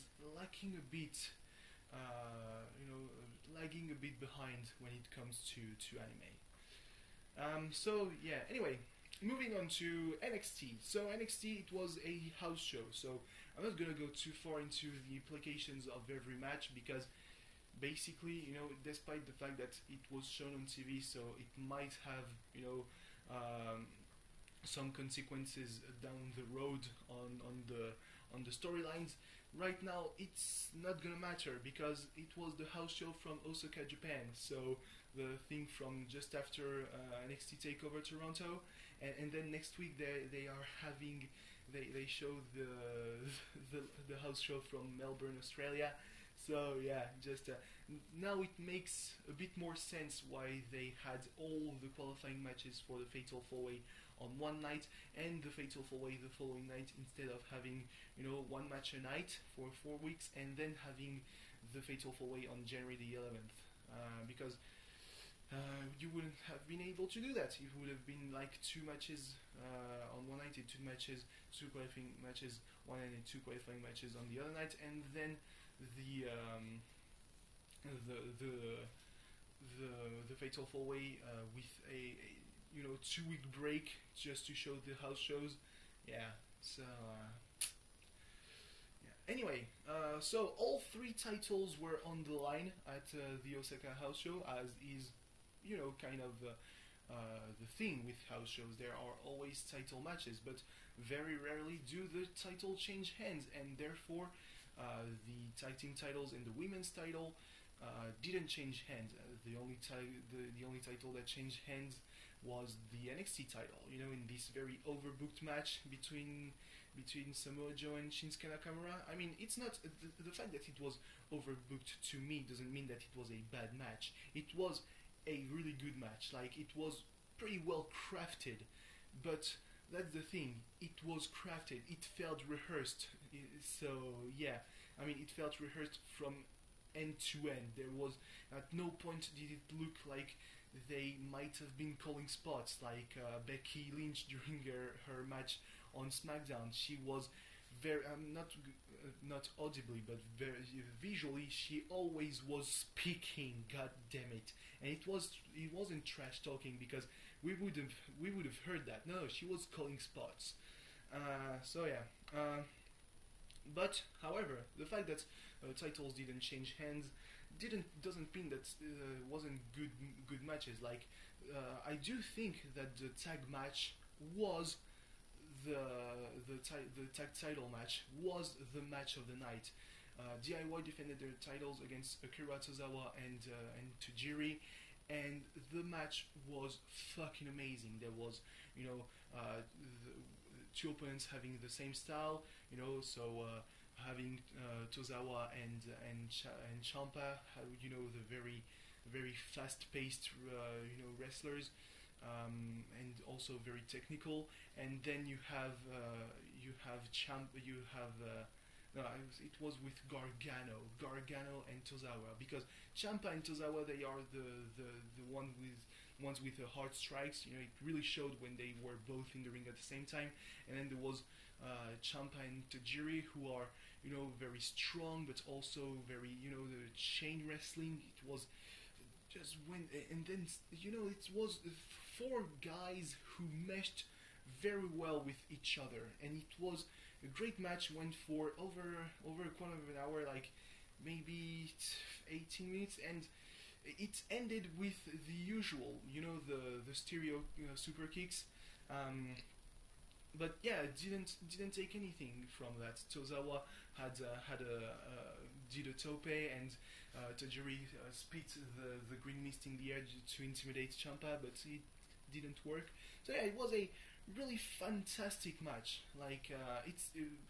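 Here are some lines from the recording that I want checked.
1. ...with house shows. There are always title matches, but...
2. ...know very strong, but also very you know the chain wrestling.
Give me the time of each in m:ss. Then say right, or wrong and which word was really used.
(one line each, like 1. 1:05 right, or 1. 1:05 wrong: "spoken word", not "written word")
1. 1:38 right
2. 3:44 right.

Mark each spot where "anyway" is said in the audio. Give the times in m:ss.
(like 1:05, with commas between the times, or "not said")
0:08, 1:29.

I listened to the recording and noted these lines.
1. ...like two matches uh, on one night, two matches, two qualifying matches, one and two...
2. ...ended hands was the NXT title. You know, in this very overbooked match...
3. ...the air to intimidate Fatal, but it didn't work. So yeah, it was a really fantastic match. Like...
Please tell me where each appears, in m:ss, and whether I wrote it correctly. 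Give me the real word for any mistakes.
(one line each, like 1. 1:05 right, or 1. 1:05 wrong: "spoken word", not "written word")
1. 1:08 right
2. 1:51 wrong: "changed", not "ended"
3. 4:19 wrong: "Ciampa", not "Fatal".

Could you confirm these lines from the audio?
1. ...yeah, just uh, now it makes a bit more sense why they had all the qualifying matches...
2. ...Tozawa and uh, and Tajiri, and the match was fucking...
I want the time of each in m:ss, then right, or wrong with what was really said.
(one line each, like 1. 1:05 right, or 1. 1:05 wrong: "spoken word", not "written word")
1. 0:46 right
2. 3:02 right.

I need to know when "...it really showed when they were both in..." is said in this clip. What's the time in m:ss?
3:37.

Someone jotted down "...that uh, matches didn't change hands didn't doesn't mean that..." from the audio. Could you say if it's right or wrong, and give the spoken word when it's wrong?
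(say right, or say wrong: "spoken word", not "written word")
wrong: "titles", not "matches".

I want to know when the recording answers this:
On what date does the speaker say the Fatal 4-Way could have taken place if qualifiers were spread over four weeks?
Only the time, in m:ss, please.
1:02.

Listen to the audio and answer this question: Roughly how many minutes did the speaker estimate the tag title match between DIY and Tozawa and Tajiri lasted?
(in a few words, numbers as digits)
18 minutes.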